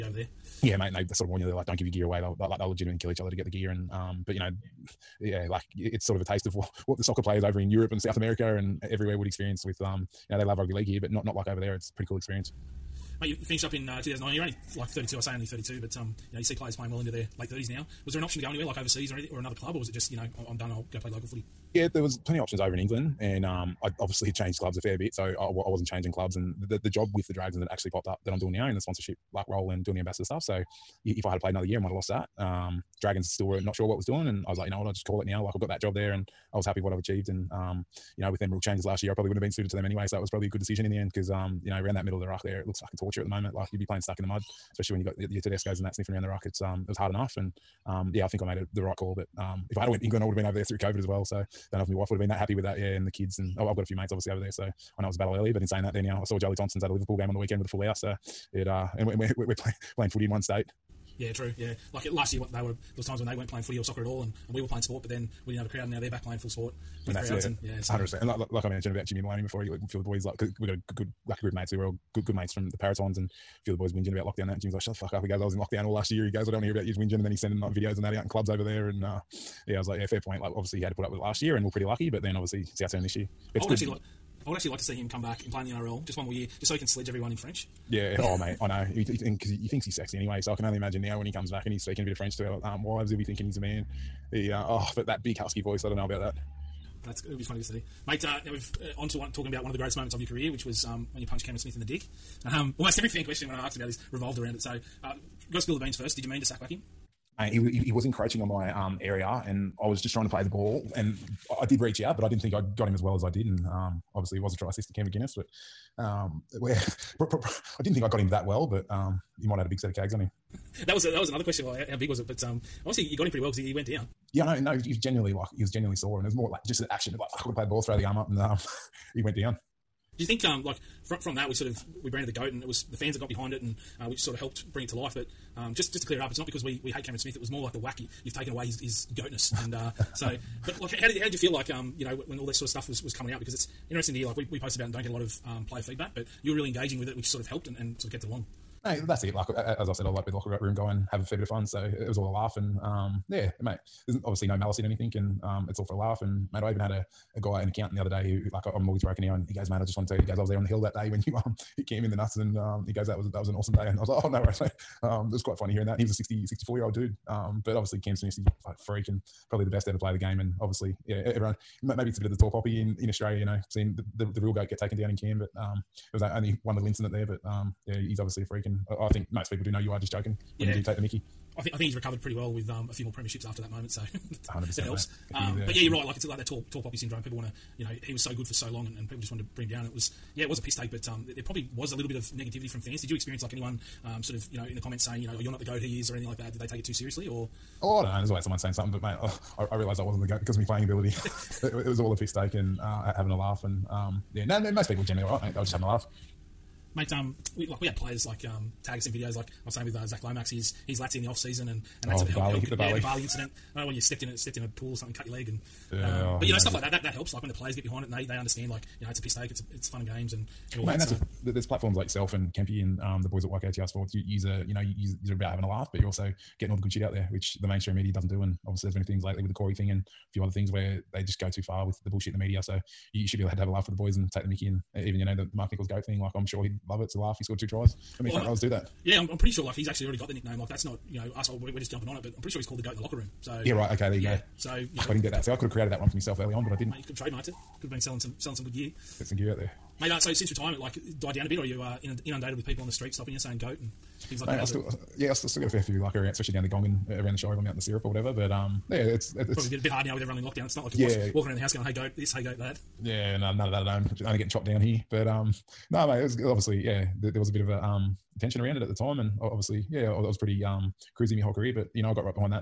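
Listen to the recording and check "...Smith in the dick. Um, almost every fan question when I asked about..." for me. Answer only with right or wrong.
right.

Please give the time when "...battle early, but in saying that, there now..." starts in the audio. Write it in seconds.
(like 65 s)
55 s.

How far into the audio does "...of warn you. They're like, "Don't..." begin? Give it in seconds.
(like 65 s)
1 s.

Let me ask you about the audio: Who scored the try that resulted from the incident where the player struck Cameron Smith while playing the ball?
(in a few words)
Cam McInnes.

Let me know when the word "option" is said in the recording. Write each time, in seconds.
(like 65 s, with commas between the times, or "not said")
18 s, 22 s.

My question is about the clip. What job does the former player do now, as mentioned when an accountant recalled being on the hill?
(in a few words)
Mortgage broker.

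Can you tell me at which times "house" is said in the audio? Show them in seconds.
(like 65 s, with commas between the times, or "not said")
57 s, 261 s.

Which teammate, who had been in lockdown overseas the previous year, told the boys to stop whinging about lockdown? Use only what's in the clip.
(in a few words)
Jimmy Maloney.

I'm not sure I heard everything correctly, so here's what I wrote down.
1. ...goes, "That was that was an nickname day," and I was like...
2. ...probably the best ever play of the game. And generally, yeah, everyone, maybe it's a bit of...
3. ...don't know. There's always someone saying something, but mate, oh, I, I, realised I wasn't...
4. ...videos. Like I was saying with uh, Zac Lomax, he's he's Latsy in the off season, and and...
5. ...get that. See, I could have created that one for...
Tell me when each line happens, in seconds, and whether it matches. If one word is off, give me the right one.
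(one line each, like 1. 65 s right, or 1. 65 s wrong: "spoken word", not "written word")
1. 162 s wrong: "awesome", not "nickname"
2. 169 s wrong: "obviously", not "generally"
3. 198 s right
4. 209 s right
5. 245 s right.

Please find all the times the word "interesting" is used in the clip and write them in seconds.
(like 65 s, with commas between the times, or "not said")
143 s.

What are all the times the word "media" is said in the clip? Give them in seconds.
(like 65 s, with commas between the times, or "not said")
227 s, 232 s.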